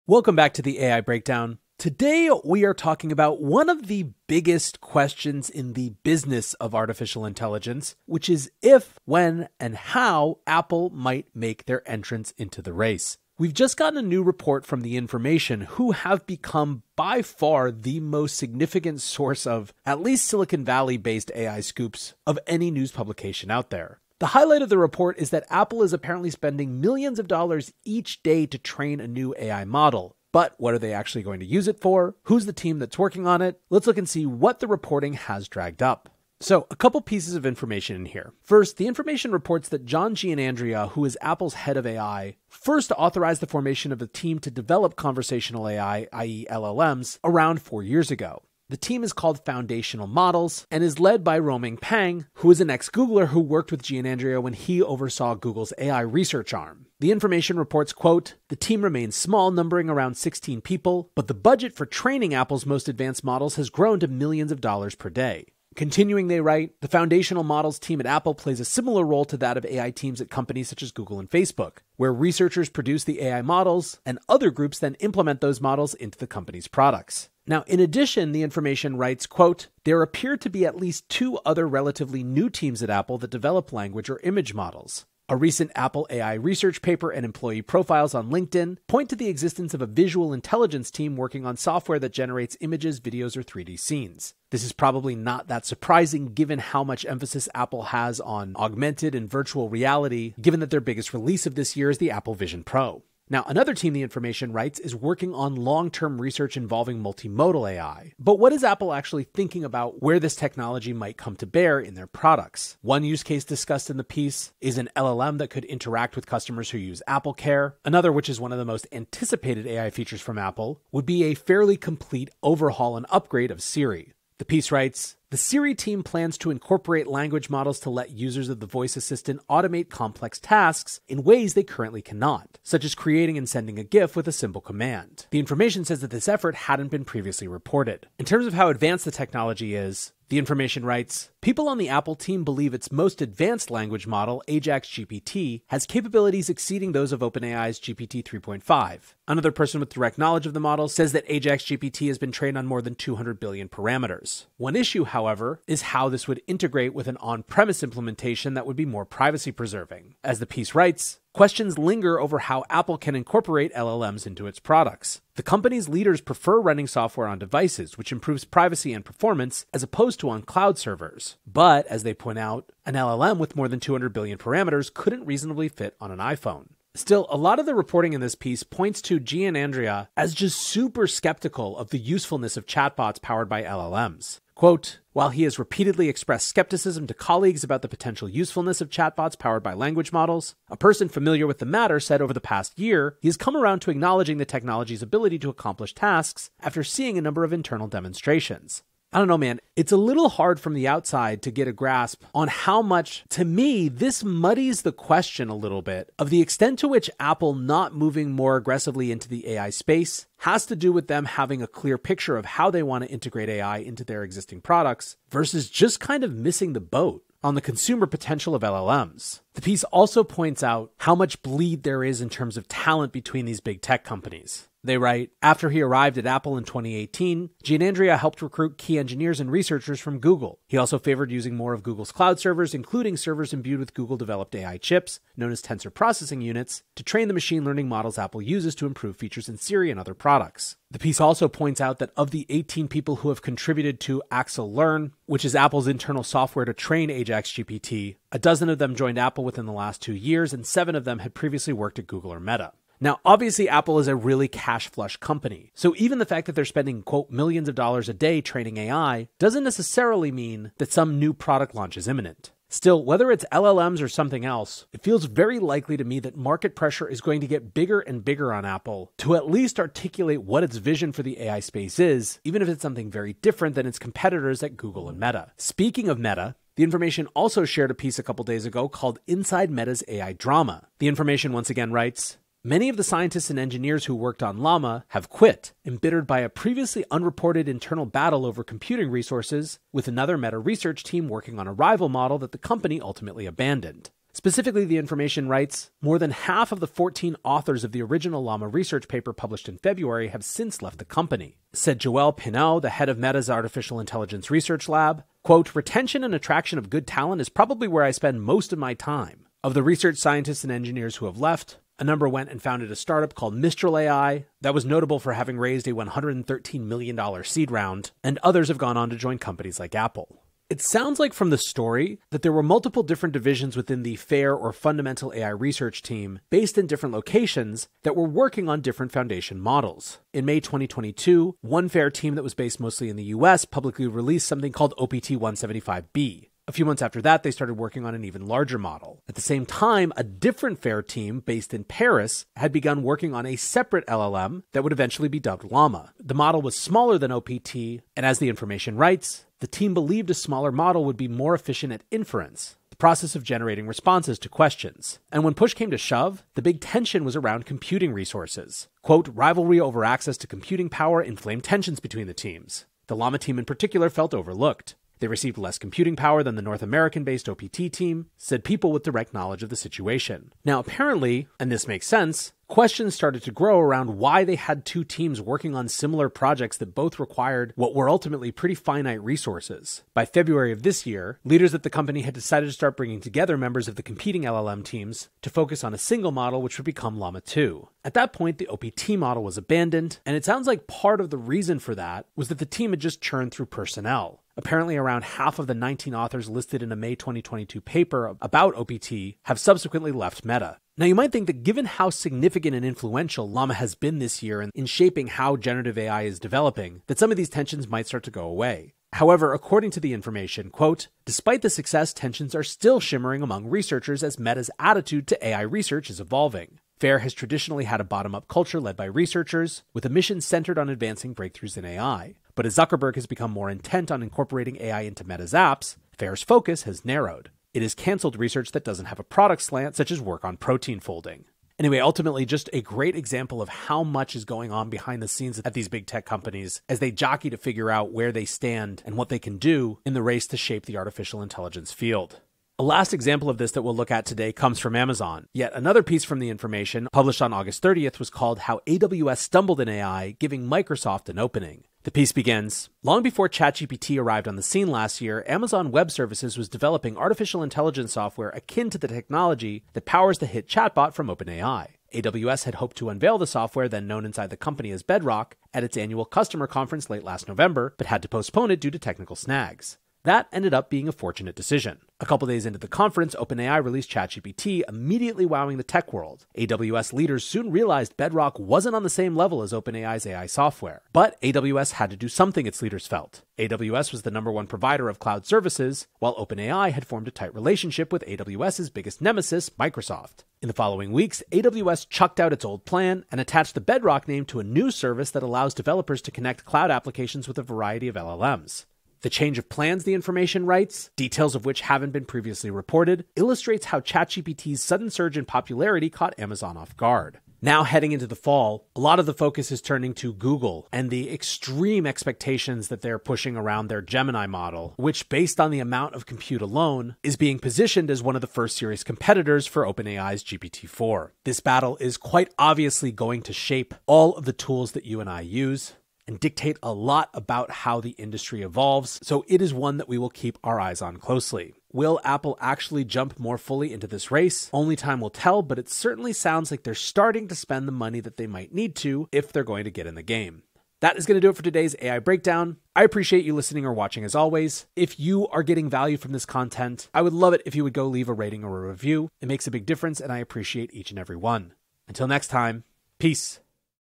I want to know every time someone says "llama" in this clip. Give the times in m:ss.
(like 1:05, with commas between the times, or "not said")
4:44, 4:58, 5:45, 6:03, 6:27, 6:43.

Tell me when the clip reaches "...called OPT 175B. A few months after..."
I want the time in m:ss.
5:34.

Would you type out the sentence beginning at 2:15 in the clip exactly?
The information says that this effort hadn't been previously reported.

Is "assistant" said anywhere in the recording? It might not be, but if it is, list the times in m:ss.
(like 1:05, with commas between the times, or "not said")
2:08.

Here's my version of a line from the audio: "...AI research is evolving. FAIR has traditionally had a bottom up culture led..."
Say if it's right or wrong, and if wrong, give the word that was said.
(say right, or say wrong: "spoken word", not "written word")
right.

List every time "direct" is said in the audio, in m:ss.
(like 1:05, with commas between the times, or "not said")
2:29, 6:09.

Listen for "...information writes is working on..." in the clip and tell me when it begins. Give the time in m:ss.
1:44.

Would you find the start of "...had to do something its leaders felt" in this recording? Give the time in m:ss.
8:01.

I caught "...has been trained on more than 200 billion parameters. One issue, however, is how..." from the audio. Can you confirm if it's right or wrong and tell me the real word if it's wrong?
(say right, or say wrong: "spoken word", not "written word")
right.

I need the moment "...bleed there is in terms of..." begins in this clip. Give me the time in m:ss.
3:41.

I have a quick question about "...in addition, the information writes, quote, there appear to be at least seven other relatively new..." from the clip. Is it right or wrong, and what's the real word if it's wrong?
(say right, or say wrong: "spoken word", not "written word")
wrong: "two", not "seven".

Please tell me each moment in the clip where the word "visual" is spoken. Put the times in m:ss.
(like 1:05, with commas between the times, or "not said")
1:29.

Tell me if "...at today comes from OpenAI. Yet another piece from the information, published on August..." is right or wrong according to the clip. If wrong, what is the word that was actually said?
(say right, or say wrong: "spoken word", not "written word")
wrong: "Amazon", not "OpenAI".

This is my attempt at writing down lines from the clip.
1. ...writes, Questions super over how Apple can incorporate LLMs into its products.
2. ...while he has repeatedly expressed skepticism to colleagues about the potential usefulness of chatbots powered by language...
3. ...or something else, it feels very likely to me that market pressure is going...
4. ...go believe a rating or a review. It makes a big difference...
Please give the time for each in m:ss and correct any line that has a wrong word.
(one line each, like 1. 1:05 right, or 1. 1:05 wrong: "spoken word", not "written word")
1. 2:40 wrong: "linger", not "super"
2. 3:05 right
3. 4:24 right
4. 9:07 wrong: "leave", not "believe".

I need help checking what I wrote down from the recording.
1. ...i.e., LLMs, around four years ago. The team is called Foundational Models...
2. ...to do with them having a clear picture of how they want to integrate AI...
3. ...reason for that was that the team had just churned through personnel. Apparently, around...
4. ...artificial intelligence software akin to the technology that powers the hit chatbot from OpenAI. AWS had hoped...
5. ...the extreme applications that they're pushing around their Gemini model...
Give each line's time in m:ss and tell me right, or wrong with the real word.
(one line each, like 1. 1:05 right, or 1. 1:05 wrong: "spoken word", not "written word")
1. 0:46 right
2. 3:30 right
3. 6:31 right
4. 7:37 right
5. 8:31 wrong: "expectations", not "applications".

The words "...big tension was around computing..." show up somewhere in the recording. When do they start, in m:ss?
5:56.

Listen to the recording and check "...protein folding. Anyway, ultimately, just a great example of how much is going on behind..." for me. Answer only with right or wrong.
right.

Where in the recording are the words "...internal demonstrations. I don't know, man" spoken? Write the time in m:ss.
3:17.